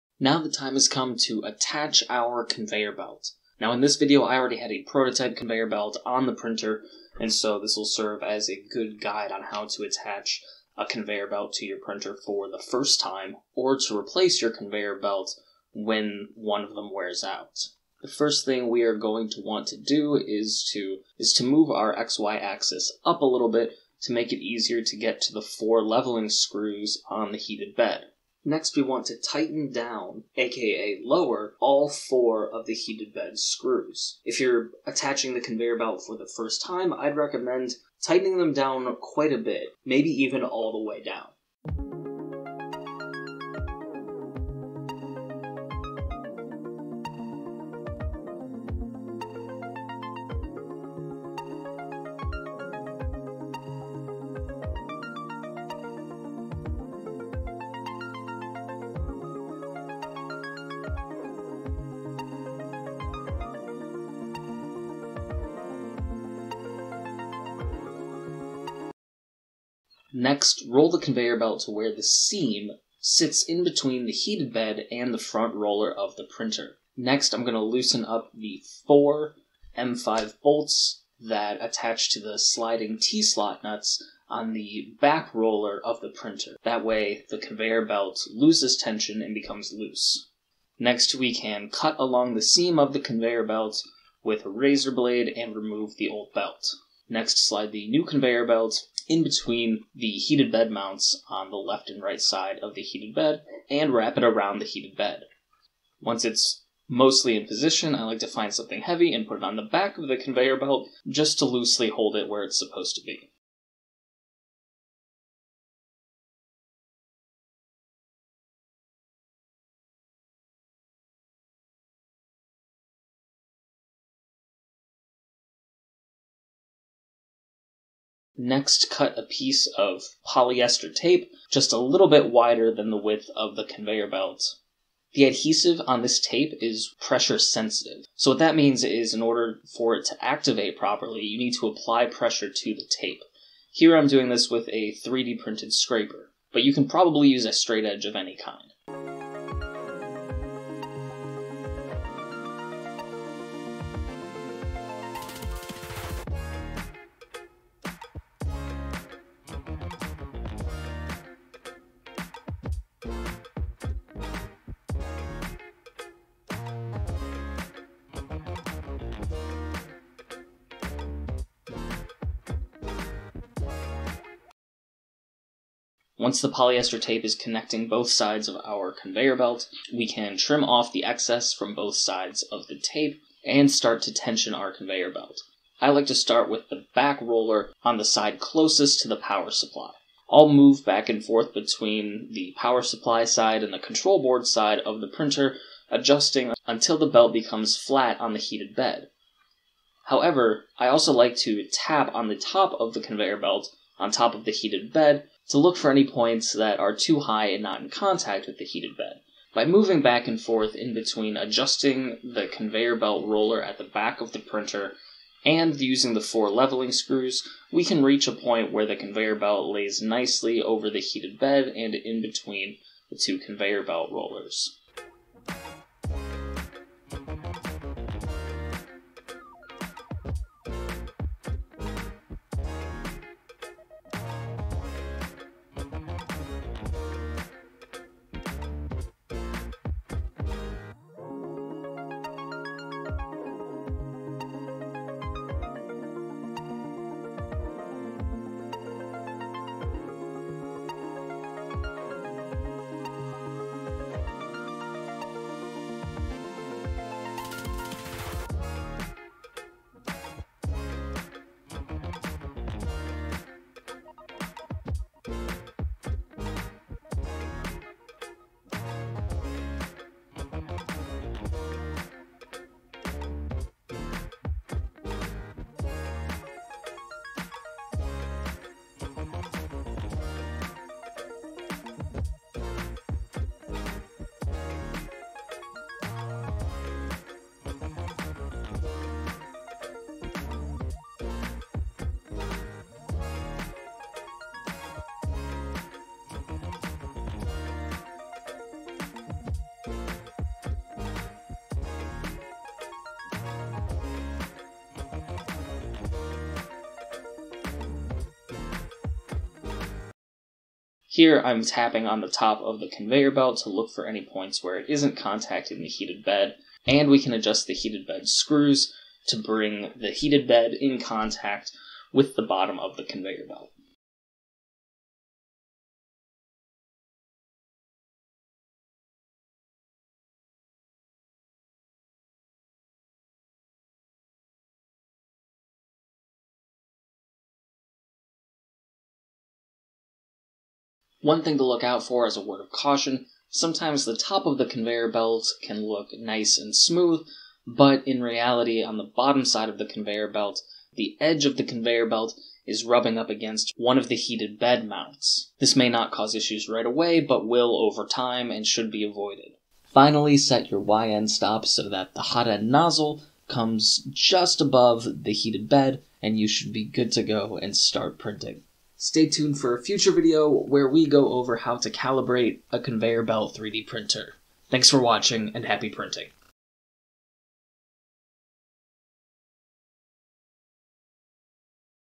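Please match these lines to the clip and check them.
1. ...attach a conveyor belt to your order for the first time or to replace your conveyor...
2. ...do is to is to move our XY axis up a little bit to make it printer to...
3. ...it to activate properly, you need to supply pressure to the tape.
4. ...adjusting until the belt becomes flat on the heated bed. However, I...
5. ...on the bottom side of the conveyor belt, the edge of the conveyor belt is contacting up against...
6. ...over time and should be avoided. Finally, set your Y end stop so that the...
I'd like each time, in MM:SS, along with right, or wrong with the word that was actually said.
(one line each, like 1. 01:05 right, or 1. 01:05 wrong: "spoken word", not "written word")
1. 00:09 wrong: "printer", not "order"
2. 00:19 wrong: "easier", not "printer"
3. 02:19 wrong: "apply", not "supply"
4. 03:15 right
5. 05:48 wrong: "rubbing", not "contacting"
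6. 05:57 right.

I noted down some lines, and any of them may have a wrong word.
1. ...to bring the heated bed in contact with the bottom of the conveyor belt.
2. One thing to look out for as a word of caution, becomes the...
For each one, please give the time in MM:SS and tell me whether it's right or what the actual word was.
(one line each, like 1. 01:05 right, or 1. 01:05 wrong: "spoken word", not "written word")
1. 05:19 right
2. 05:41 wrong: "sometimes", not "becomes".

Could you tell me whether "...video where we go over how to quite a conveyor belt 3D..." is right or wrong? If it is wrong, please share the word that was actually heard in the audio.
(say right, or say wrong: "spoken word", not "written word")
wrong: "calibrate", not "quite".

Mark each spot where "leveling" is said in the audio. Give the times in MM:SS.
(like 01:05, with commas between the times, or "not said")
00:25, 03:36.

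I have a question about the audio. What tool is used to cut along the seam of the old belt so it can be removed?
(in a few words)
Razor blade.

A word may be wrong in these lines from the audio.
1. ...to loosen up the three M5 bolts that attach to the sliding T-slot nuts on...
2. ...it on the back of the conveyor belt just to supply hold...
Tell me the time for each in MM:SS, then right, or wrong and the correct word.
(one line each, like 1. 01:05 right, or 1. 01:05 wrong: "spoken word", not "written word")
1. 01:17 wrong: "four", not "three"
2. 01:49 wrong: "loosely", not "supply".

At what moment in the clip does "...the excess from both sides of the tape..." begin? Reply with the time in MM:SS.
03:00.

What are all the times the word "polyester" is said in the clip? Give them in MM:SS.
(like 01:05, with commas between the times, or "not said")
02:10, 02:56.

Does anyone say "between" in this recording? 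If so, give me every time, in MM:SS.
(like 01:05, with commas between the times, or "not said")
01:13, 01:39, 03:11, 03:30, 03:42.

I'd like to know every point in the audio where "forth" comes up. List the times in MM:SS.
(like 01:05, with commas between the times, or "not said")
03:11, 03:30.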